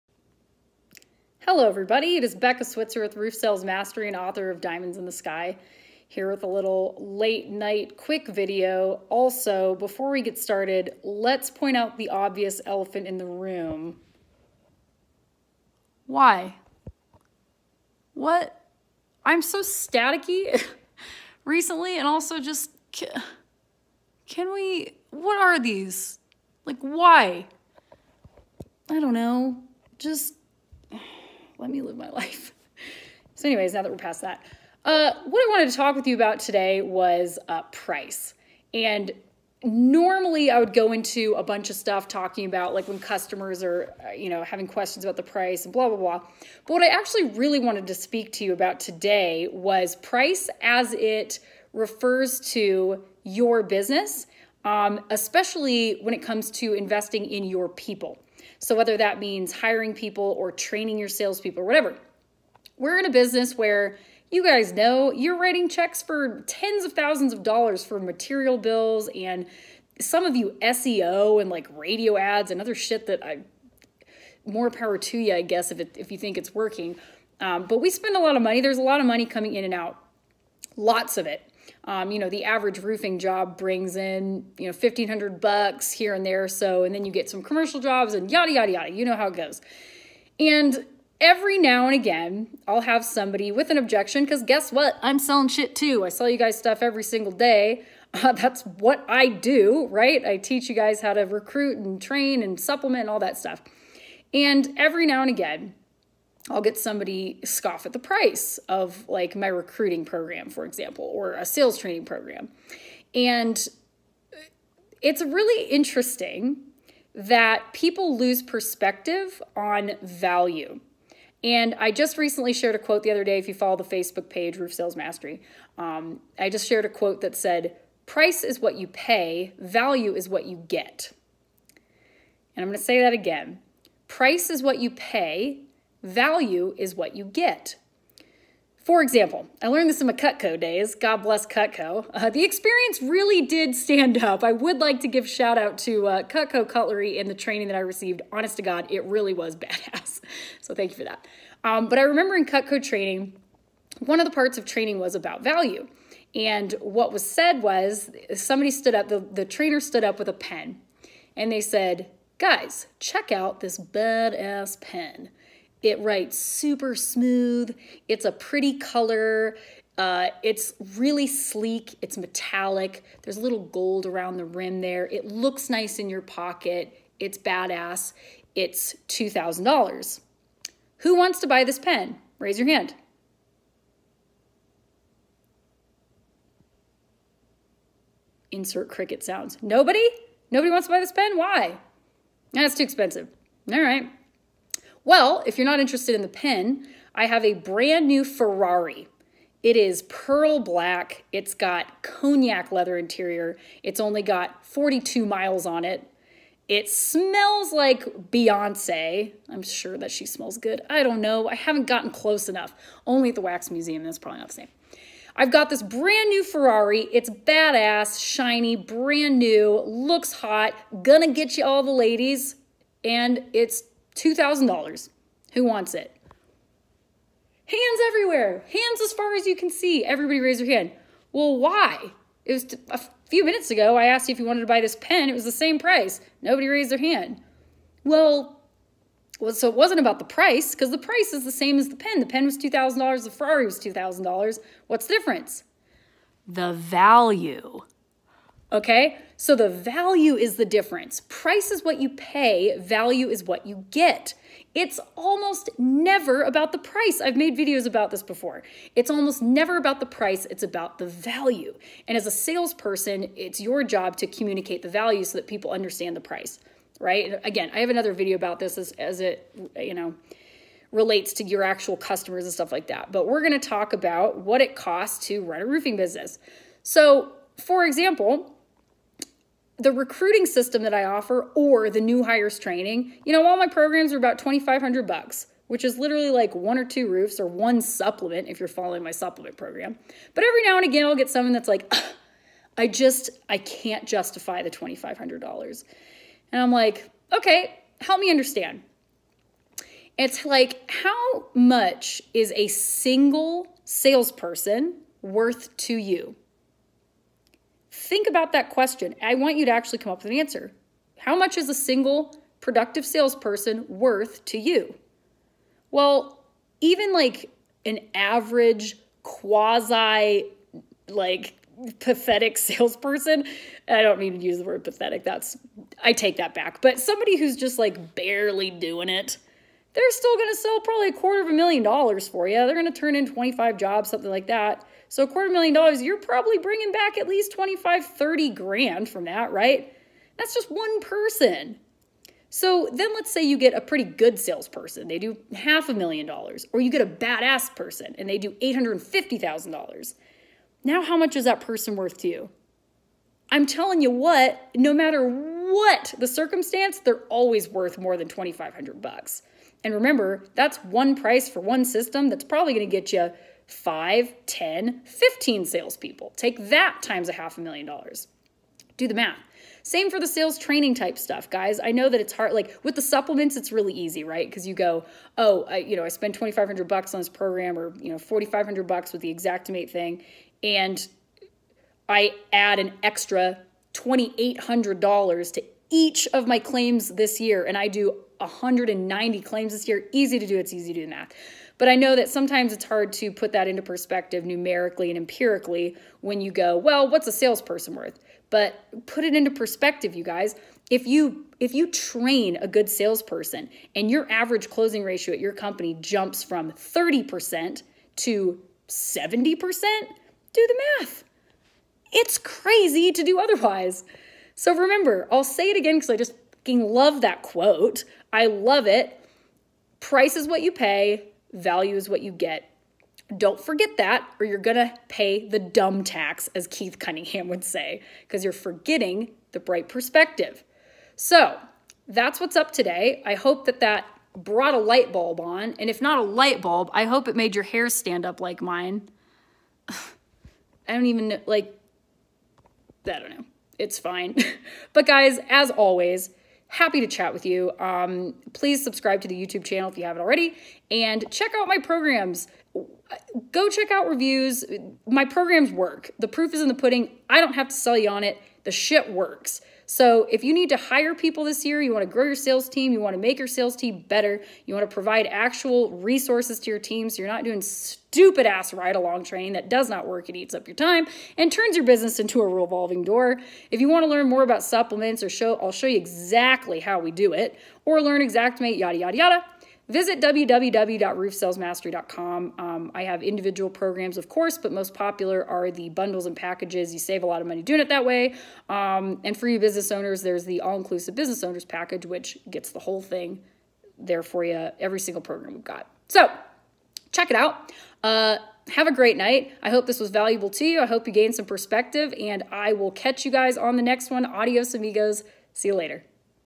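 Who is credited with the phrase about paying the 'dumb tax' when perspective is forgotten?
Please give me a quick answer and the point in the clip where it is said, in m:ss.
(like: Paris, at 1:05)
Keith Cunningham, at 7:06.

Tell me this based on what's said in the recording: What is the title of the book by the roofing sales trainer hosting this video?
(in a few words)
Diamonds in the Sky.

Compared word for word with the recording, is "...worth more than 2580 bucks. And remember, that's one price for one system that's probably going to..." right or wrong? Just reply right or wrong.
wrong.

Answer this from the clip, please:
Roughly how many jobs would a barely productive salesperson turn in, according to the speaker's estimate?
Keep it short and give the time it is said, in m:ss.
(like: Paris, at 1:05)
25, at 5:33.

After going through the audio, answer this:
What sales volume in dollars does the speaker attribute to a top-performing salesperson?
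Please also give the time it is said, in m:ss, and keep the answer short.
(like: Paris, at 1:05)
$850,000, at 5:48.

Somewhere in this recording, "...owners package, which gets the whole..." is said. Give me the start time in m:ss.
8:11.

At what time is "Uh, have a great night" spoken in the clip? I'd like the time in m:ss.
8:18.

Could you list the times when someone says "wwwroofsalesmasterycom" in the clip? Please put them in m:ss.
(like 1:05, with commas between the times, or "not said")
8:00.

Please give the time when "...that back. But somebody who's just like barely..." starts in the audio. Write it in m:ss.
5:26.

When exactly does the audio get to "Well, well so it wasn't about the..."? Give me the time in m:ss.
3:58.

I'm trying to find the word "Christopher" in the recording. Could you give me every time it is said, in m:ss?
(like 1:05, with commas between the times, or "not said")
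not said.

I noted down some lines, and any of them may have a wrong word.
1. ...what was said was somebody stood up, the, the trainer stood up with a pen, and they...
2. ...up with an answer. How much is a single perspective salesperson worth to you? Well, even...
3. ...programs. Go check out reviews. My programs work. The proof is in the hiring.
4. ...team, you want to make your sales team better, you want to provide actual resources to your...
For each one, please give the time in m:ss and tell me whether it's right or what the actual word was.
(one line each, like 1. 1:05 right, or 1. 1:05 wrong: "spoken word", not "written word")
1. 2:36 right
2. 5:10 wrong: "productive", not "perspective"
3. 7:31 wrong: "pudding", not "hiring"
4. 7:42 right.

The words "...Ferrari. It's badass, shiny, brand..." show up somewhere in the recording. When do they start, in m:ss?
3:36.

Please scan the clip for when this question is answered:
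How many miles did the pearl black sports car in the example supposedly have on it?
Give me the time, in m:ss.
3:24.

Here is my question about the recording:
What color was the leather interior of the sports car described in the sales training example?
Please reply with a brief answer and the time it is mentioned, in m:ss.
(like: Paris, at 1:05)
Cognac, at 3:22.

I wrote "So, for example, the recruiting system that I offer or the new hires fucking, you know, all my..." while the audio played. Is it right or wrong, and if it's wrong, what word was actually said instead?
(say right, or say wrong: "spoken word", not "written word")
wrong: "training", not "fucking".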